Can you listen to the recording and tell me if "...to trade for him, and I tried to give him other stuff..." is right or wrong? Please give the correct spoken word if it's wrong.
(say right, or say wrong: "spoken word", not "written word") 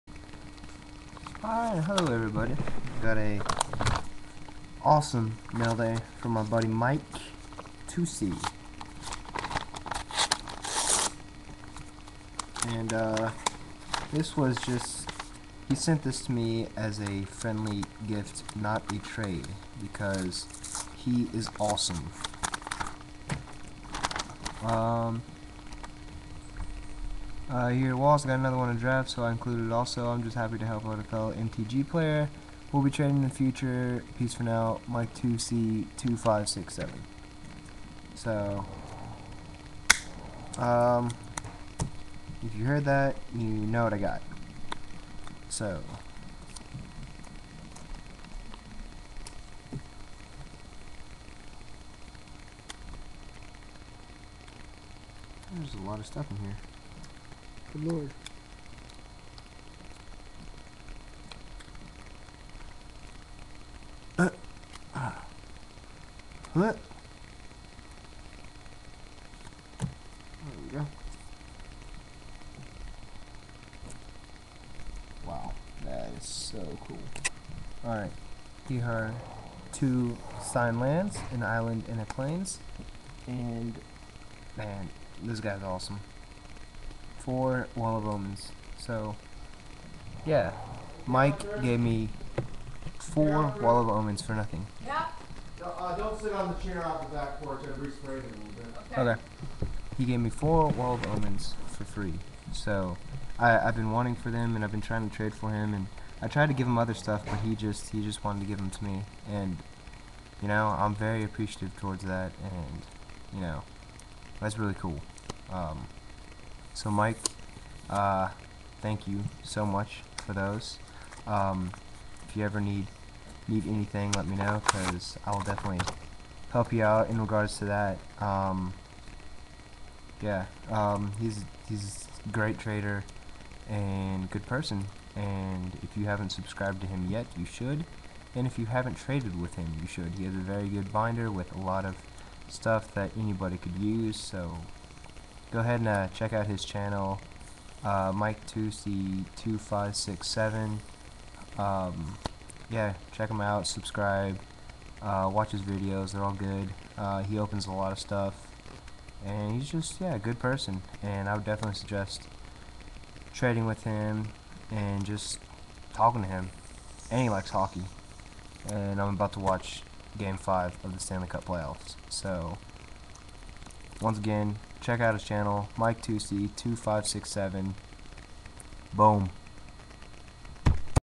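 right.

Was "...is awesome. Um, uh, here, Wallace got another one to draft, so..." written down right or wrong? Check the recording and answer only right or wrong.
right.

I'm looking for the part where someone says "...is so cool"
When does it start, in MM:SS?
01:16.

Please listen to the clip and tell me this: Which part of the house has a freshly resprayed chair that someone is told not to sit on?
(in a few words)
Back porch.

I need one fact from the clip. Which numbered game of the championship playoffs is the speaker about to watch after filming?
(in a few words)
Game 5.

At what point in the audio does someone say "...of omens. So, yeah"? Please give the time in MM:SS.
01:27.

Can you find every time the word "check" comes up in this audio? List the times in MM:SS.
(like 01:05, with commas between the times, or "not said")
02:26, 02:33, 02:54.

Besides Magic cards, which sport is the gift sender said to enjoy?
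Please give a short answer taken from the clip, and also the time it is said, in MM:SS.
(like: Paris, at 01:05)
Hockey, at 02:47.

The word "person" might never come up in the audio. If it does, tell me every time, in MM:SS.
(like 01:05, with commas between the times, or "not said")
02:14, 02:40.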